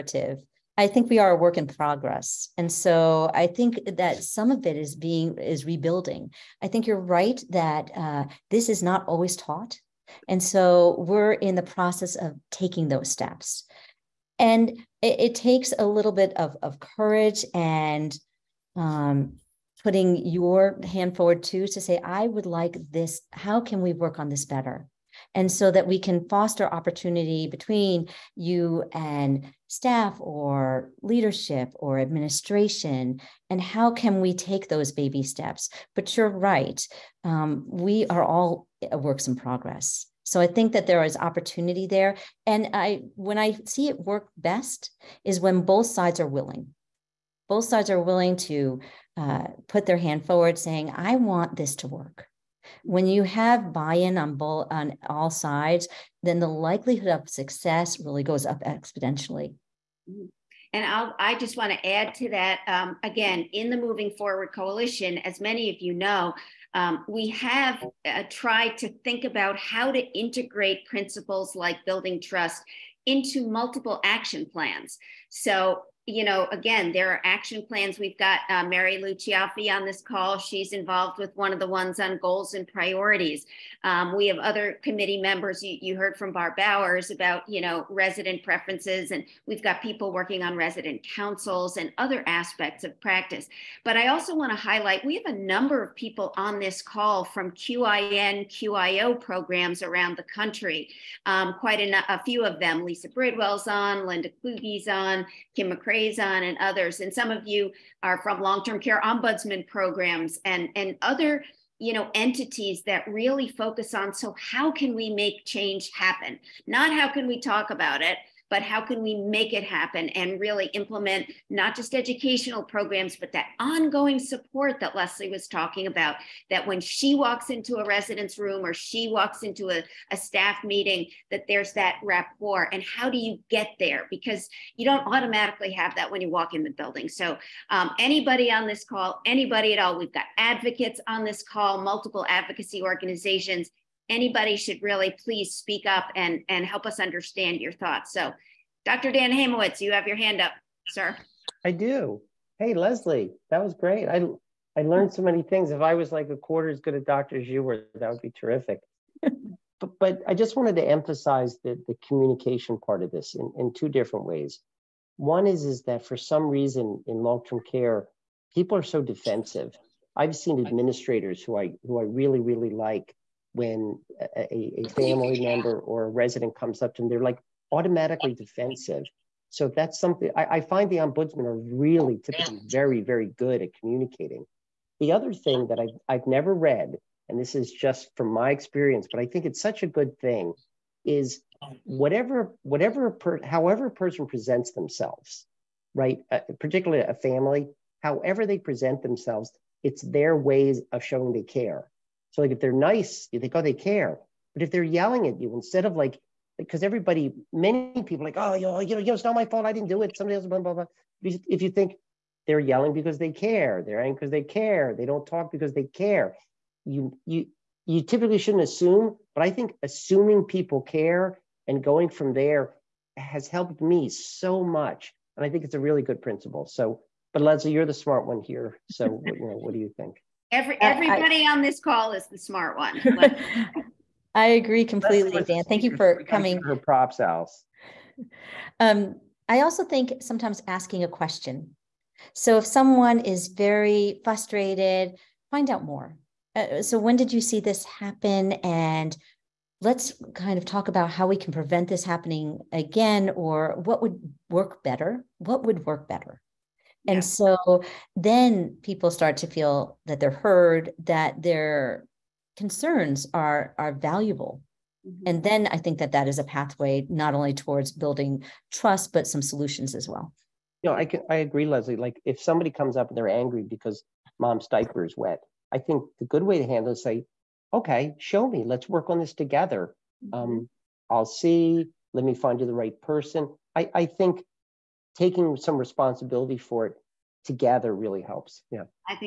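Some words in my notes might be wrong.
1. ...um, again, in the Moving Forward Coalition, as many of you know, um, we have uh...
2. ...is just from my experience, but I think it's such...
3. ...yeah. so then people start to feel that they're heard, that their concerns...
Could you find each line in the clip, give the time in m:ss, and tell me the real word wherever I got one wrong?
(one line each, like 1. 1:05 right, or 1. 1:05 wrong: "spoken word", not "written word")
1. 1:02 right
2. 3:07 right
3. 4:17 right.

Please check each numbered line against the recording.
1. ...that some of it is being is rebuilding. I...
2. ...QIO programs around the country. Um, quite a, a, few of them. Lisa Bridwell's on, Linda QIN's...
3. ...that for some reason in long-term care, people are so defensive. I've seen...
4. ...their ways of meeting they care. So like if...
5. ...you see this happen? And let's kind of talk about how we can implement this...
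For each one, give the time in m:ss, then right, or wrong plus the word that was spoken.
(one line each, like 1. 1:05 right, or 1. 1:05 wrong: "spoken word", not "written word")
1. 0:03 right
2. 1:38 wrong: "Kluge", not "QIN"
3. 2:45 right
4. 3:20 wrong: "showing", not "meeting"
5. 4:07 wrong: "prevent", not "implement".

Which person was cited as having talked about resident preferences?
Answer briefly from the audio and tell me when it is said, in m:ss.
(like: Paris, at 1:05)
Barb Bowers, at 1:26.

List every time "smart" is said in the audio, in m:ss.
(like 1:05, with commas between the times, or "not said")
3:47, 3:52.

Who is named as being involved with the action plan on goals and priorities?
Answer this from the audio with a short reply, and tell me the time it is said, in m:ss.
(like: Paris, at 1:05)
Mary Lou Chiaffi, at 1:18.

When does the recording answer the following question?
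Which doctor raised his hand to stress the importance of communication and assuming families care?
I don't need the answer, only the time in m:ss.
2:29.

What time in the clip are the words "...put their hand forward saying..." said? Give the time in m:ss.
0:49.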